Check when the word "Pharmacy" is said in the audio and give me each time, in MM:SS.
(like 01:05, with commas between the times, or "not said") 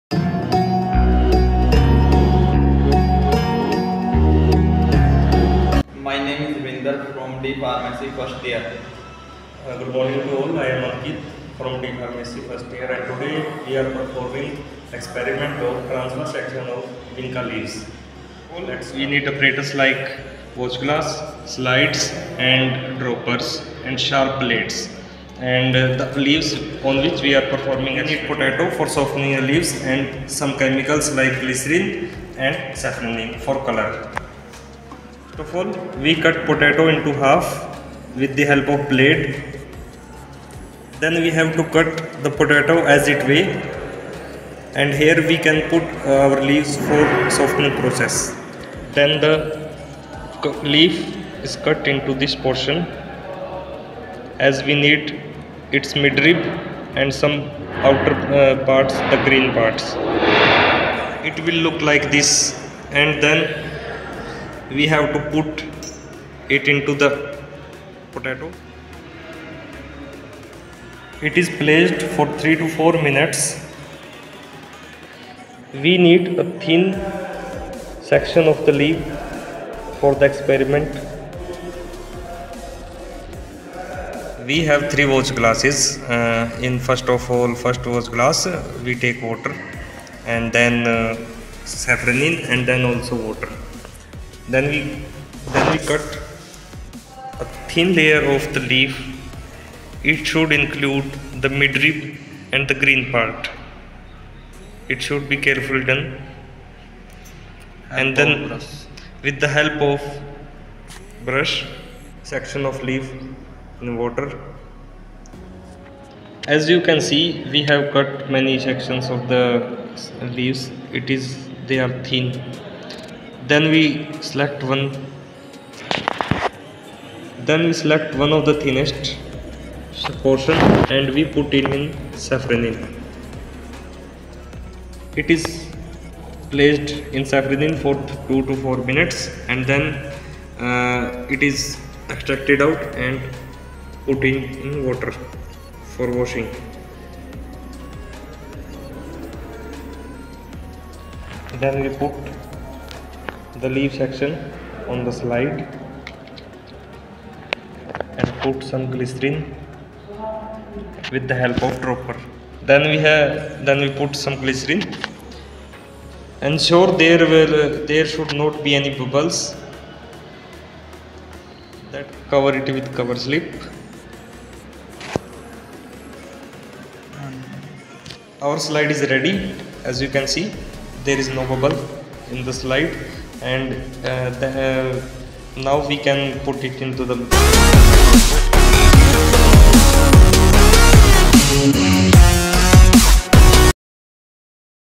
00:07, 00:11.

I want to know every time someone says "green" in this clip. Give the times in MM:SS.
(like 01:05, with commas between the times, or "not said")
00:59, 01:42.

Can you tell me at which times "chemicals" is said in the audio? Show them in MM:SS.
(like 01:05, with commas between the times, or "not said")
00:30.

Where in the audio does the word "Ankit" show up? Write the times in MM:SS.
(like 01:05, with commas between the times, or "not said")
00:10.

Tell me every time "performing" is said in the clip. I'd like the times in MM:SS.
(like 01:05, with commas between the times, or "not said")
00:13, 00:27.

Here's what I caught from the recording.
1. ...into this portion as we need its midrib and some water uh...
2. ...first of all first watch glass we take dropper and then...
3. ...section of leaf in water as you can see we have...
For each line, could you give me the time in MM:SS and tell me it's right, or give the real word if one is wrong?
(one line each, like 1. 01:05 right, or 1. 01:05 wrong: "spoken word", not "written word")
1. 00:51 wrong: "outer", not "water"
2. 01:26 wrong: "water", not "dropper"
3. 01:52 right.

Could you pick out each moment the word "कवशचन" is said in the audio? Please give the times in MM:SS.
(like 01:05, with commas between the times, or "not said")
not said.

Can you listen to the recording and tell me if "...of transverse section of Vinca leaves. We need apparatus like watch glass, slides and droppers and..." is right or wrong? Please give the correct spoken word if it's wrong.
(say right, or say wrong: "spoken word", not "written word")
right.